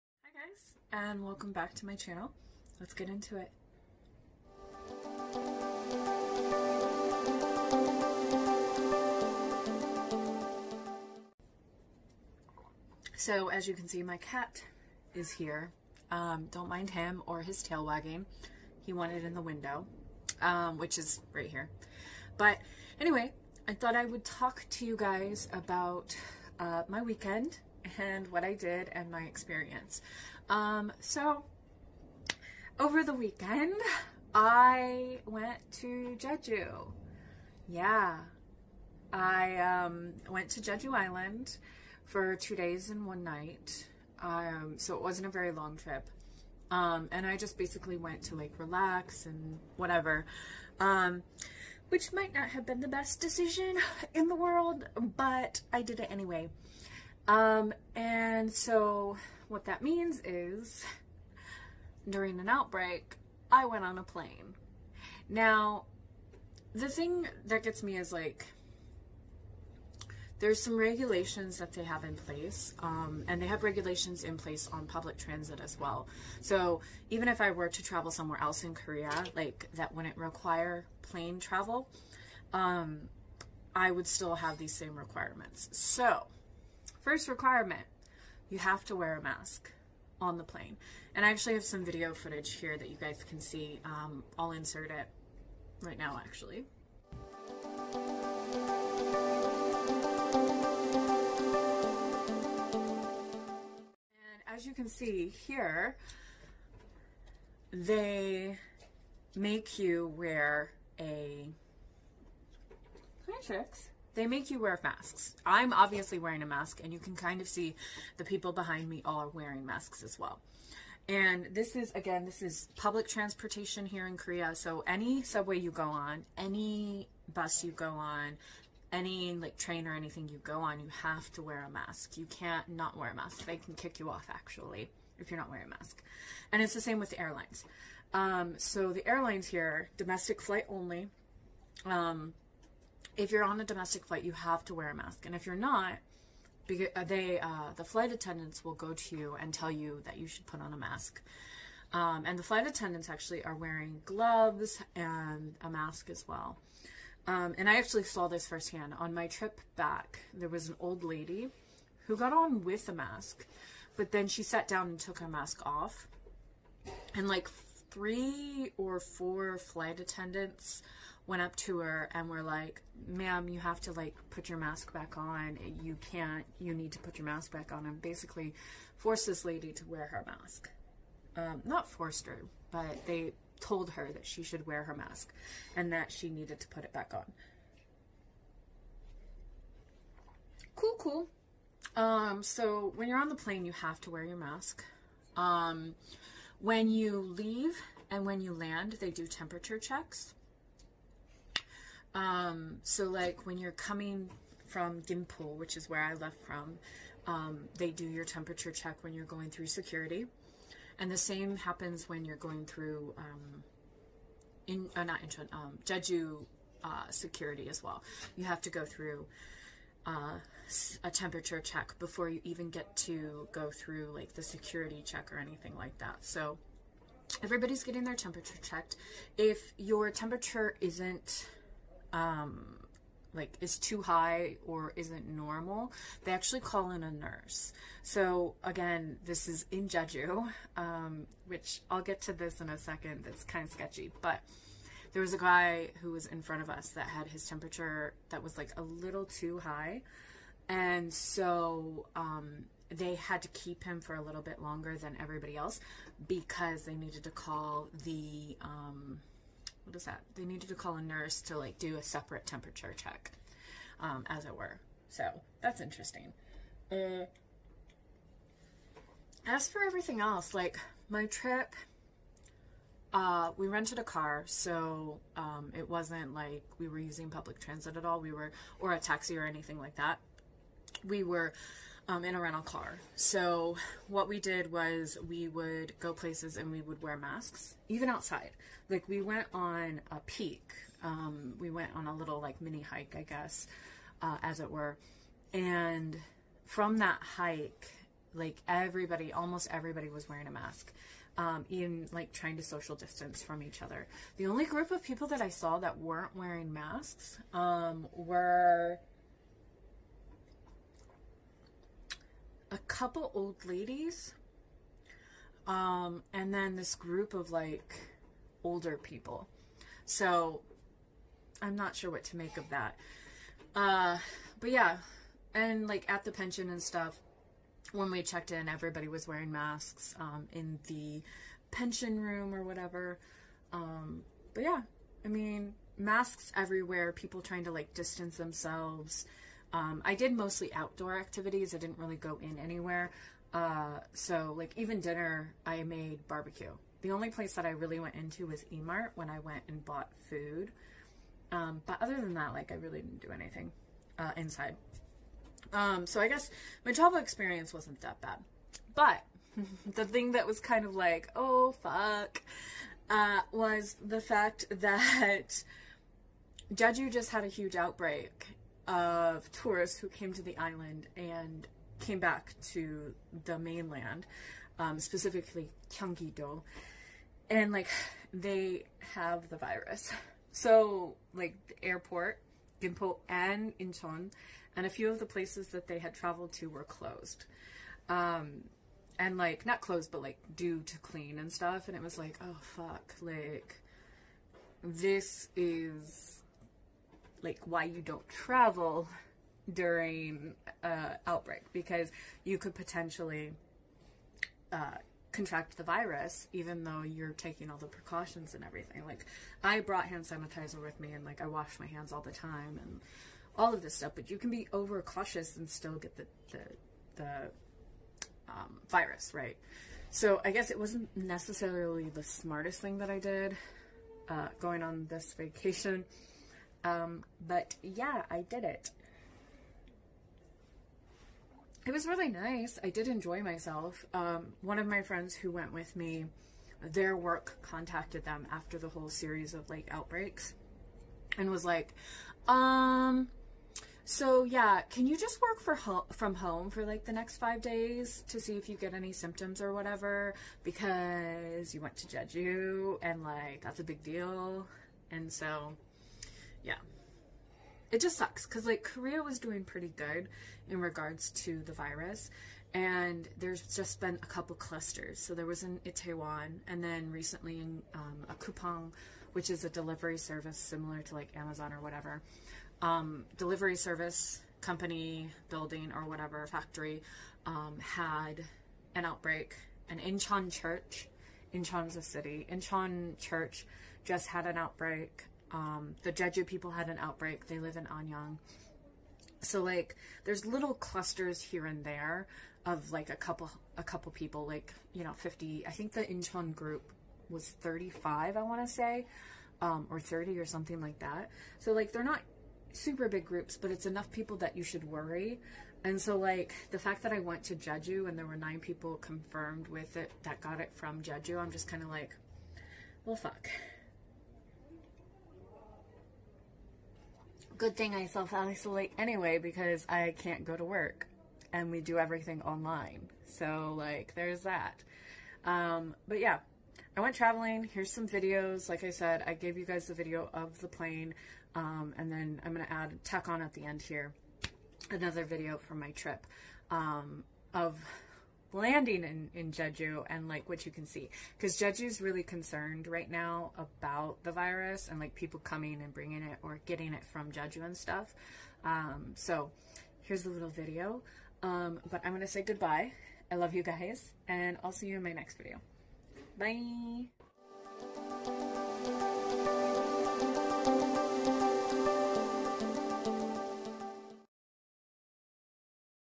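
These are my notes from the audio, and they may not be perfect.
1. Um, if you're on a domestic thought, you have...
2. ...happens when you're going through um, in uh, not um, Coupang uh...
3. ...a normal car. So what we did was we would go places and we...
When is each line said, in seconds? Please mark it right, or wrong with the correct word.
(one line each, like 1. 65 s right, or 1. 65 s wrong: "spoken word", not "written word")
1. 141 s wrong: "flight", not "thought"
2. 211 s wrong: "Jeju", not "Coupang"
3. 282 s wrong: "rental", not "normal".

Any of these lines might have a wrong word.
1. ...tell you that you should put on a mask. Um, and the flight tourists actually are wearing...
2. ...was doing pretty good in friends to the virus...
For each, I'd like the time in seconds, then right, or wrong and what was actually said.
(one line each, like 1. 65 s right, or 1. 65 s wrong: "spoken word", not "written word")
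1. 149 s wrong: "attendants", not "tourists"
2. 459 s wrong: "regards", not "friends".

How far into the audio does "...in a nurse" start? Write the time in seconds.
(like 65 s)
236 s.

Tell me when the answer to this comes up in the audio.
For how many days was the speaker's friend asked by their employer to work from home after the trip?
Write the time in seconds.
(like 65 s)
447 s.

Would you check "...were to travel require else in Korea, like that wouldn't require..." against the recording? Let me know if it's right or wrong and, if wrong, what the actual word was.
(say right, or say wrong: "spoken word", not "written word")
wrong: "somewhere", not "require".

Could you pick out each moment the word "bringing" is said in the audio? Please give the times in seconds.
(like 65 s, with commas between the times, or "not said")
545 s.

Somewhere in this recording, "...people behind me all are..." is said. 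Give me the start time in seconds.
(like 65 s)
118 s.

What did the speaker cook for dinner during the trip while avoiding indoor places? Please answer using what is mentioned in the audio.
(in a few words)
Barbecue.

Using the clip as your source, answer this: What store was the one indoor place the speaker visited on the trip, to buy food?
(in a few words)
Emart.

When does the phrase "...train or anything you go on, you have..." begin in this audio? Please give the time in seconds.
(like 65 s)
129 s.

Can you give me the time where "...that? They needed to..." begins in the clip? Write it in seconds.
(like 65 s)
260 s.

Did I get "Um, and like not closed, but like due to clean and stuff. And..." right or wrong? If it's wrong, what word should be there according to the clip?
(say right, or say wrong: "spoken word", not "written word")
right.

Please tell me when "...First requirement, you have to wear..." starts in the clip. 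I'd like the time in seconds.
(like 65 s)
87 s.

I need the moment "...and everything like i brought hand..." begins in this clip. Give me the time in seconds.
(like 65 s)
408 s.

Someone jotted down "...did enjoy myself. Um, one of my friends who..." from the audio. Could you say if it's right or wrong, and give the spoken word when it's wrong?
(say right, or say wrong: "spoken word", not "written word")
right.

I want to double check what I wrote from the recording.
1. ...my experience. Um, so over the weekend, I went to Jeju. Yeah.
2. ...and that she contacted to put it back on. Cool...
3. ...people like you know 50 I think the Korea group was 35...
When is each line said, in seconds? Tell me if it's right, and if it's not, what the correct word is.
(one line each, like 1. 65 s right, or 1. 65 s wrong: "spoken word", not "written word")
1. 29 s right
2. 185 s wrong: "needed", not "contacted"
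3. 494 s wrong: "Incheon", not "Korea".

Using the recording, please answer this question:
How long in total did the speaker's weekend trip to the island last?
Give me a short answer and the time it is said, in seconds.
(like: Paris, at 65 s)
2 days and 1 night, at 42 s.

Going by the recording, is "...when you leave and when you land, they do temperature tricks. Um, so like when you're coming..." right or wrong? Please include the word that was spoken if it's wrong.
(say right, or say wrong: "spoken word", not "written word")
wrong: "checks", not "tricks".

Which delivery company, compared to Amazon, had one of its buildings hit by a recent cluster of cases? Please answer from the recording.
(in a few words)
Coupang.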